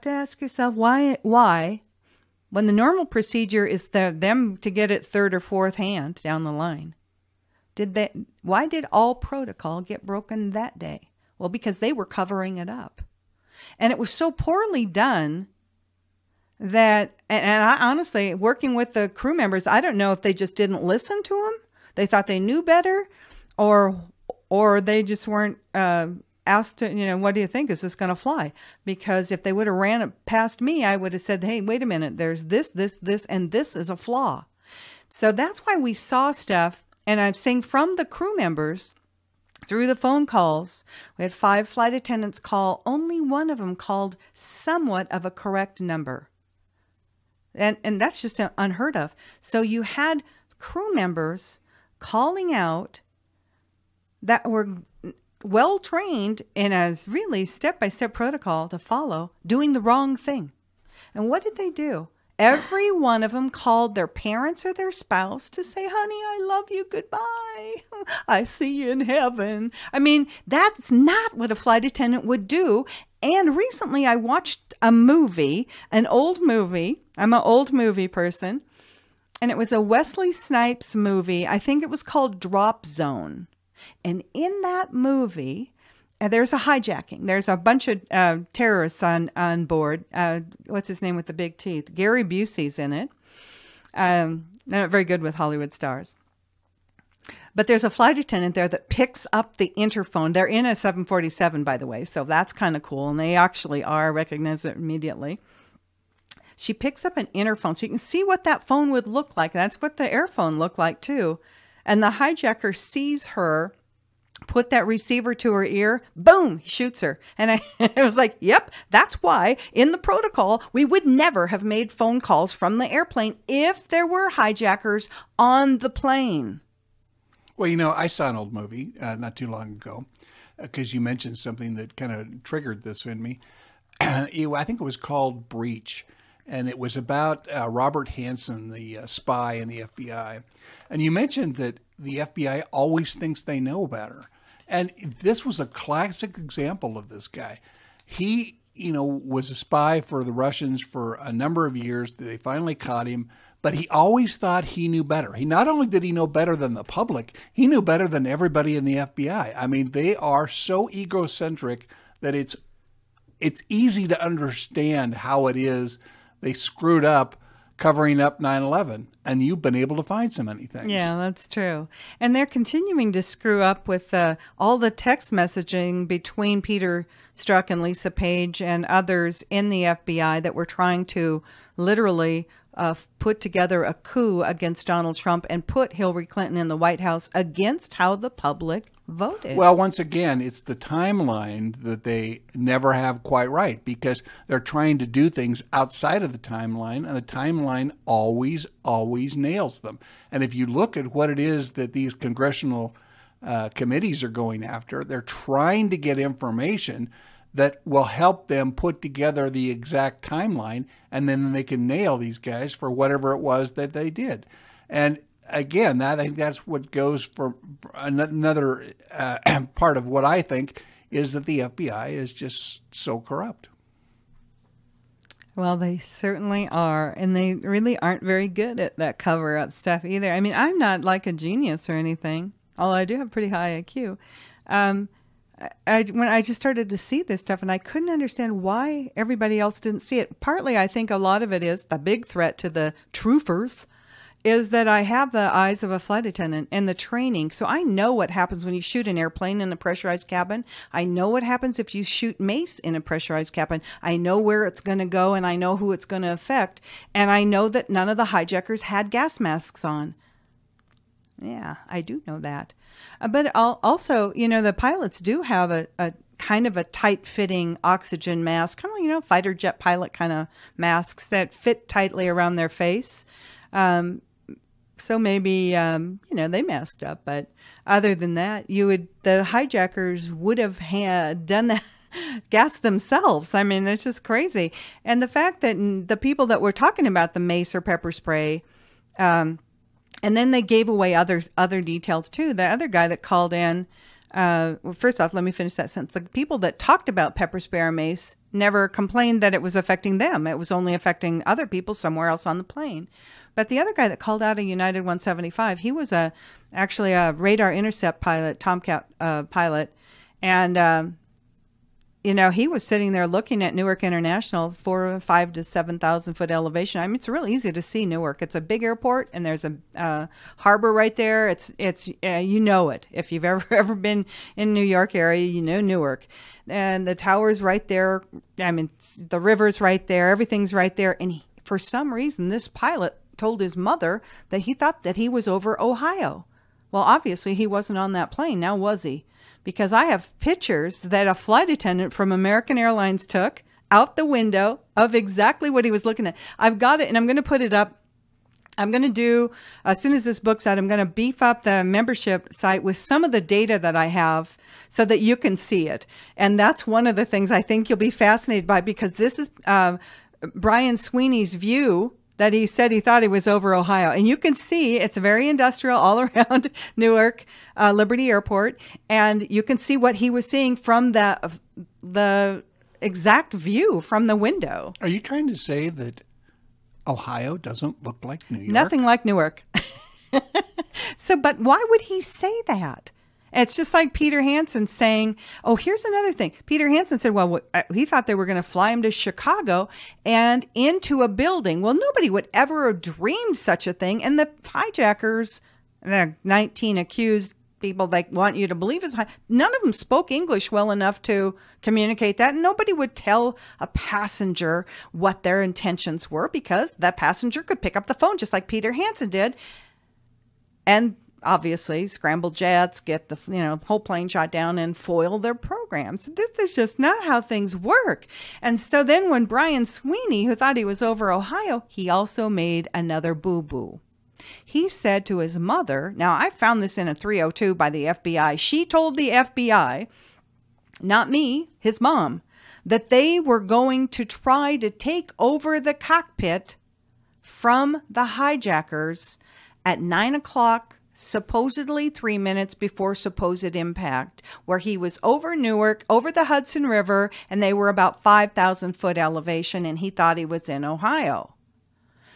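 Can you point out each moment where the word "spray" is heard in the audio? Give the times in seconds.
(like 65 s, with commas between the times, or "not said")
288 s, 297 s.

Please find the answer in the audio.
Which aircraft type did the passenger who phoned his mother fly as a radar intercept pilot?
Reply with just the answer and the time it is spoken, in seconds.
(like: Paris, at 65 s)
Tomcat, at 308 s.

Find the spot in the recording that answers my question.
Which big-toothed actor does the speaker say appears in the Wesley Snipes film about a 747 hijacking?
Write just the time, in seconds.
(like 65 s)
91 s.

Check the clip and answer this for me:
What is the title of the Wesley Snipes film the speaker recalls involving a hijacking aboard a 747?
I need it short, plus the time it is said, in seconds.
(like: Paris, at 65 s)
Drop Zone, at 82 s.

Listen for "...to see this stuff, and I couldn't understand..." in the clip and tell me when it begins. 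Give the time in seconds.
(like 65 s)
236 s.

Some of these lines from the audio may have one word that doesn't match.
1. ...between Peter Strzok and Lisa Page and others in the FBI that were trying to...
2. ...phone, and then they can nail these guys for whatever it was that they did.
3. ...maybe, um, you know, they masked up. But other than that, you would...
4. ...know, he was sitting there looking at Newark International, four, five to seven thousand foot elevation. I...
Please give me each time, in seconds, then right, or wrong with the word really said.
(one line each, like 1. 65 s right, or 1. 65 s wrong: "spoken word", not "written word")
1. 176 s right
2. 210 s wrong: "timeline", not "phone"
3. 275 s right
4. 312 s right.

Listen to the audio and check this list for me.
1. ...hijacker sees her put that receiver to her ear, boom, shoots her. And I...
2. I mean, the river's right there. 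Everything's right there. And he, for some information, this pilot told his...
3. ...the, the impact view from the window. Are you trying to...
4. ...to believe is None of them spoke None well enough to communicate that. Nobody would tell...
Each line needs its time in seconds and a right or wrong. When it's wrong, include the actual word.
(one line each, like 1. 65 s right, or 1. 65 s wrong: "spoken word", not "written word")
1. 112 s right
2. 328 s wrong: "reason", not "information"
3. 371 s wrong: "exact", not "impact"
4. 398 s wrong: "English", not "None".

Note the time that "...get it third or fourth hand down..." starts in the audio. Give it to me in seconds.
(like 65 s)
4 s.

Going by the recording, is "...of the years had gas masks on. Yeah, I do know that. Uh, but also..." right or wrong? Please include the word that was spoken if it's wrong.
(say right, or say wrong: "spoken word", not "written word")
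wrong: "hijackers", not "years".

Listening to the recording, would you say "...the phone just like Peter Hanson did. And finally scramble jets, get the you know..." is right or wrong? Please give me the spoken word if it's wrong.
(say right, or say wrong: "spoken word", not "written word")
wrong: "obviously", not "finally".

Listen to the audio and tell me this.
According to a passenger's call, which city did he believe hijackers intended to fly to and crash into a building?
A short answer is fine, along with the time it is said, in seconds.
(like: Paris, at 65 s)
Chicago, at 389 s.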